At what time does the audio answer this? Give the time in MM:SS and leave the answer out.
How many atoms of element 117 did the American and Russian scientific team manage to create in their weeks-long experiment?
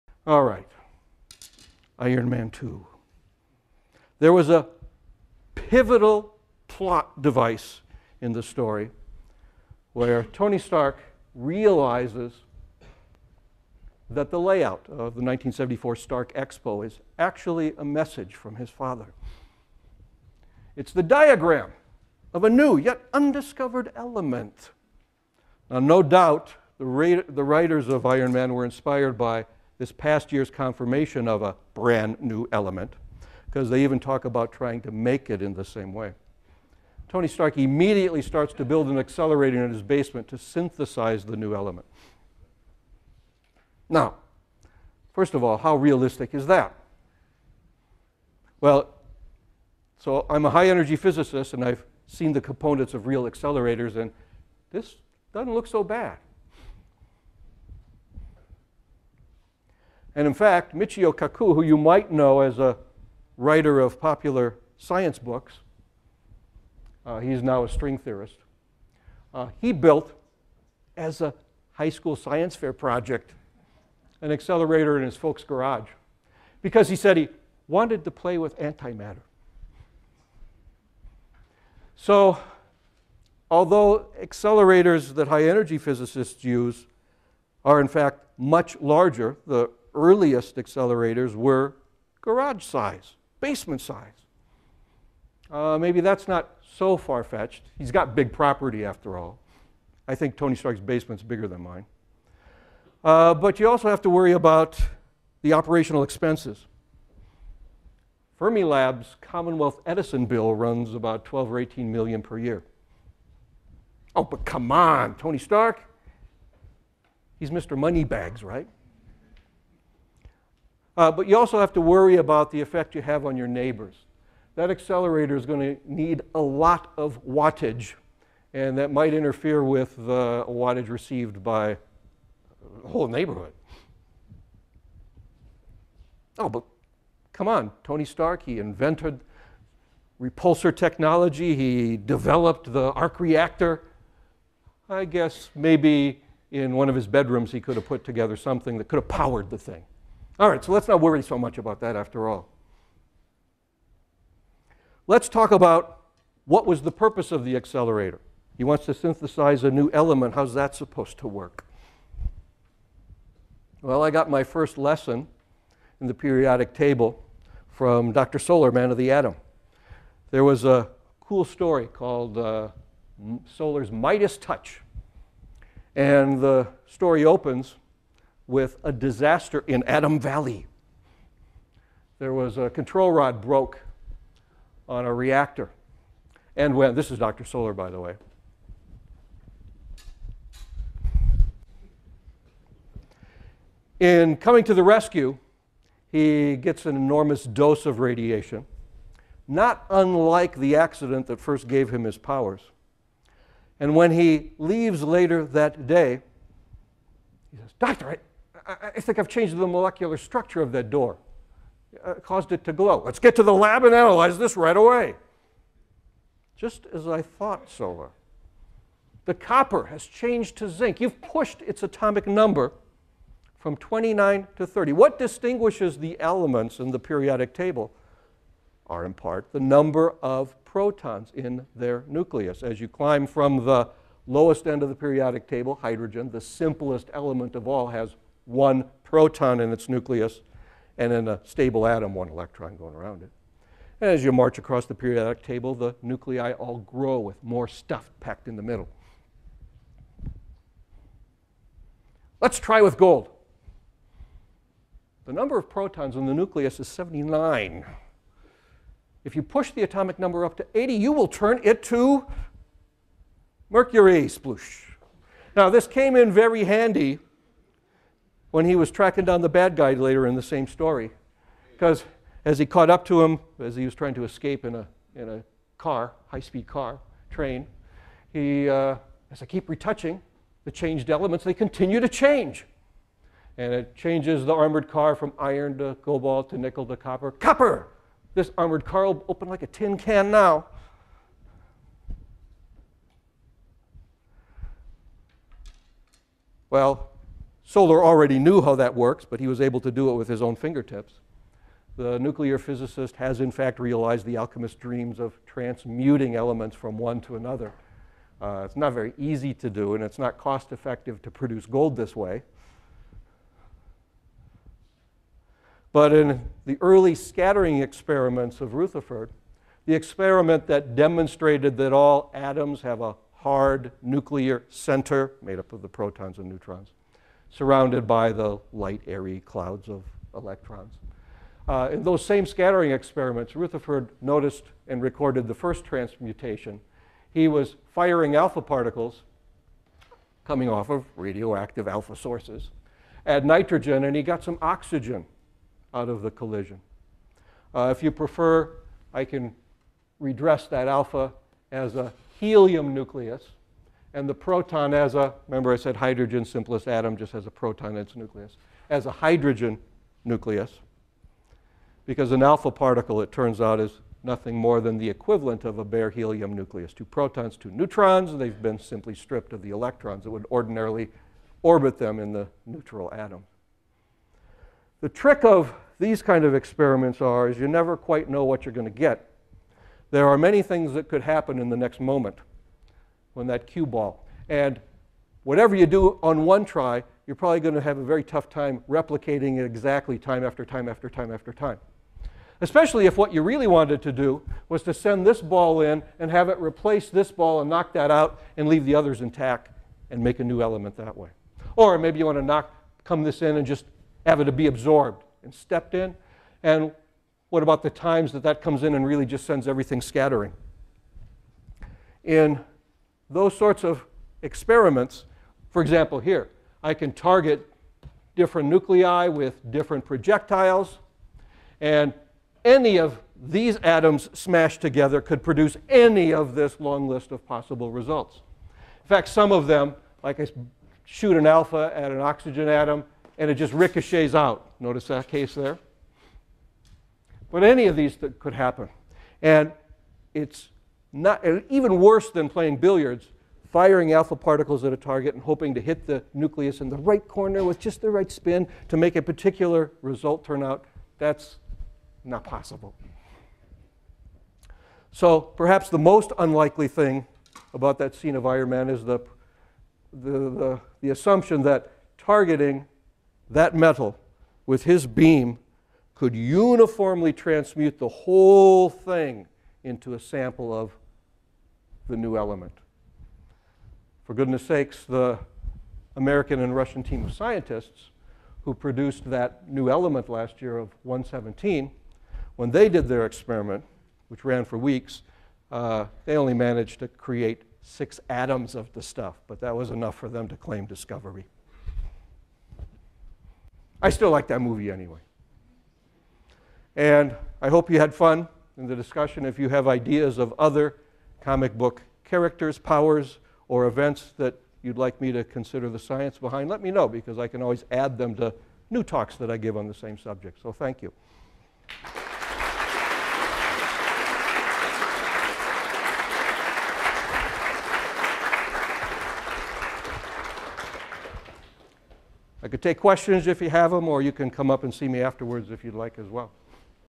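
08:07.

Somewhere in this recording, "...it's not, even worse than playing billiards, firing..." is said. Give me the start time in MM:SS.
07:20.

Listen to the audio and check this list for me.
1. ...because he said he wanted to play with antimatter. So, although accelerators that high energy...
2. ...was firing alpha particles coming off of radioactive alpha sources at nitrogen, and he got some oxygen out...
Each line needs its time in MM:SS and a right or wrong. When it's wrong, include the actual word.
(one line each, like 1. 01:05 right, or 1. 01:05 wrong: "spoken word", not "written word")
1. 01:16 right
2. 05:37 right.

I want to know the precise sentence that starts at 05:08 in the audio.
Uh, it's not very easy to do, and it's not cost effective to produce gold this way.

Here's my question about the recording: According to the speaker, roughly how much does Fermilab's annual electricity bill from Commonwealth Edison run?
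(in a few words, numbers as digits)
12 or 18 million.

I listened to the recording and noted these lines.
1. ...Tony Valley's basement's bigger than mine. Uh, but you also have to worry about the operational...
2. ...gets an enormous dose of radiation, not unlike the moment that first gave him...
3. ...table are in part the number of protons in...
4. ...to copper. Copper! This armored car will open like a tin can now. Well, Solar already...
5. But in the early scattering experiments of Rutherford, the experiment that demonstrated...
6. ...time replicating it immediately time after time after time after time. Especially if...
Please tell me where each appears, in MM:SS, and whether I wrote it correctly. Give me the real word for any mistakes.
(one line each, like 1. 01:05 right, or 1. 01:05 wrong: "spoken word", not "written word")
1. 01:40 wrong: "Stark", not "Valley"
2. 03:16 wrong: "accident", not "moment"
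3. 03:47 right
4. 04:46 right
5. 05:15 right
6. 06:28 wrong: "exactly", not "immediately".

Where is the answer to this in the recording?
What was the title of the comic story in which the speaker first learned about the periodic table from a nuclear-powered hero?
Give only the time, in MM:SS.
02:53.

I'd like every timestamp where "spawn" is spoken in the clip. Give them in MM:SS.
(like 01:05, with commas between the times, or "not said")
not said.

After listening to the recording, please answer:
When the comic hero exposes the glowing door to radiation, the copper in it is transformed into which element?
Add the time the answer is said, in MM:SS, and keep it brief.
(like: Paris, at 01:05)
zinc, at 03:40.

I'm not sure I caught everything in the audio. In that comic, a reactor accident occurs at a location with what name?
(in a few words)
Atom Valley.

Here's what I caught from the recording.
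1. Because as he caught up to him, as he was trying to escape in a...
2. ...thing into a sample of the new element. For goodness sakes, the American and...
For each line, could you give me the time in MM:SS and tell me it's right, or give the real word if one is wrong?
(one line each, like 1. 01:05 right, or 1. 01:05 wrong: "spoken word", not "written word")
1. 04:31 right
2. 07:48 right.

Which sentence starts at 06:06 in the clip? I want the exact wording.
Two protons, two neutrons, they've been simply stripped of the electrons that would ordinarily orbit them in the neutral atom.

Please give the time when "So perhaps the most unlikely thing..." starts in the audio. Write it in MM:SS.
07:35.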